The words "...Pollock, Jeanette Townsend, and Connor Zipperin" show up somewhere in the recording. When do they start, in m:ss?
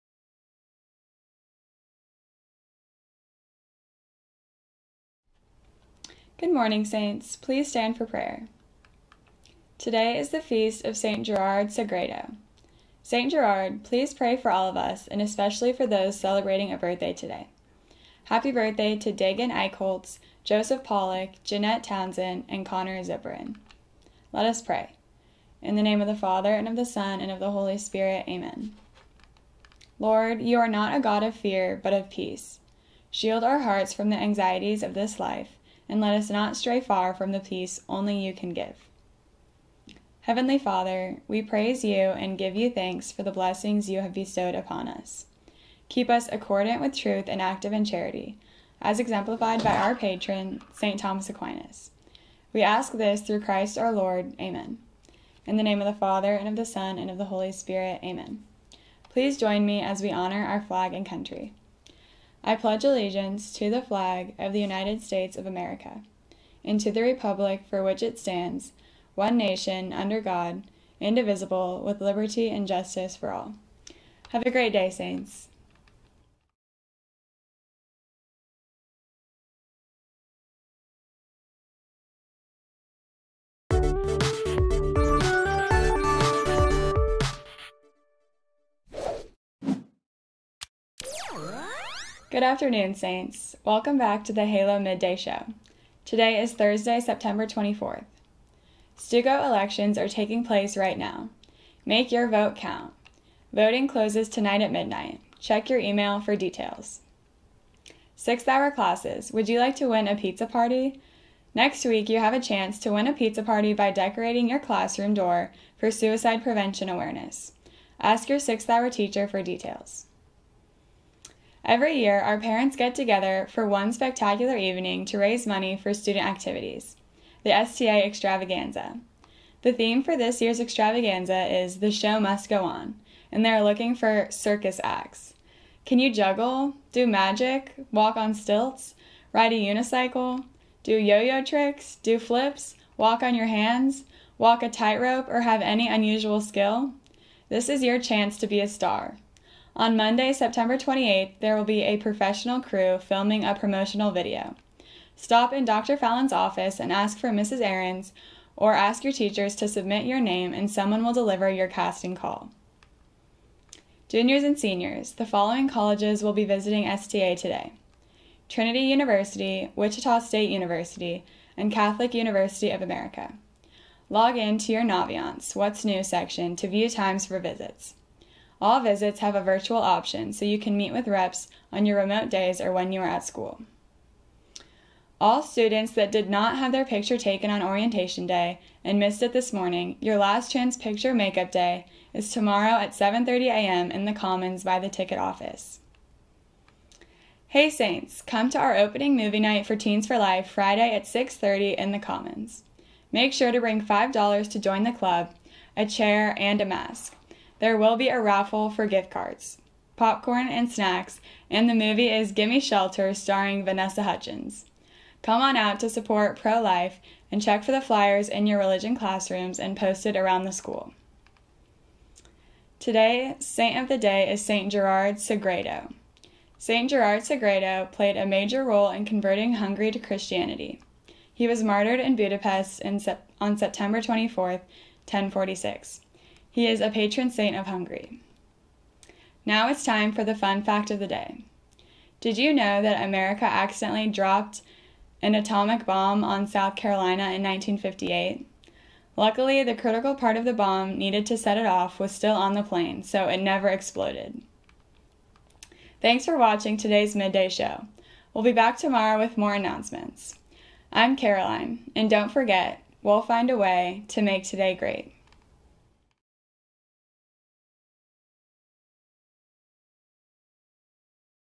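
0:20.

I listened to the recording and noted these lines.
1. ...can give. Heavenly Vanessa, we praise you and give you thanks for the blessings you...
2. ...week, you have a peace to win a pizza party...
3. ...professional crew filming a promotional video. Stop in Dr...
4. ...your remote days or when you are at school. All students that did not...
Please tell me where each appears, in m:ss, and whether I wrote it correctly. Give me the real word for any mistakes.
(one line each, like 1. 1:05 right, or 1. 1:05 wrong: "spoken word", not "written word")
1. 0:38 wrong: "Father", not "Vanessa"
2. 1:51 wrong: "chance", not "peace"
3. 2:31 right
4. 3:01 right.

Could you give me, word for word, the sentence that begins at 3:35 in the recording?
Come on out to support pro life and check for the flyers in your religion classrooms and posted around the school.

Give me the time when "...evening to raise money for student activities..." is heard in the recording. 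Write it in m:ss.
2:04.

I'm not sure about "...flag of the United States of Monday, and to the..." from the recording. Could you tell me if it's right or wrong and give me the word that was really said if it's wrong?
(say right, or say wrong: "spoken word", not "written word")
wrong: "America", not "Monday".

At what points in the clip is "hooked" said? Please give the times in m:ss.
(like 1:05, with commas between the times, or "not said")
not said.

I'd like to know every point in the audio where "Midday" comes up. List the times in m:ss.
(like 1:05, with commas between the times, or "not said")
1:34, 4:17.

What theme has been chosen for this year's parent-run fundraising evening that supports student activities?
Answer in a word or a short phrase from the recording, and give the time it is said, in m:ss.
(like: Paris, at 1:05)
The Show Must Go On, at 2:11.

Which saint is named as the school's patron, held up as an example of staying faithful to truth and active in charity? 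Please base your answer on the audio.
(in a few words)
St. Thomas Aquinas.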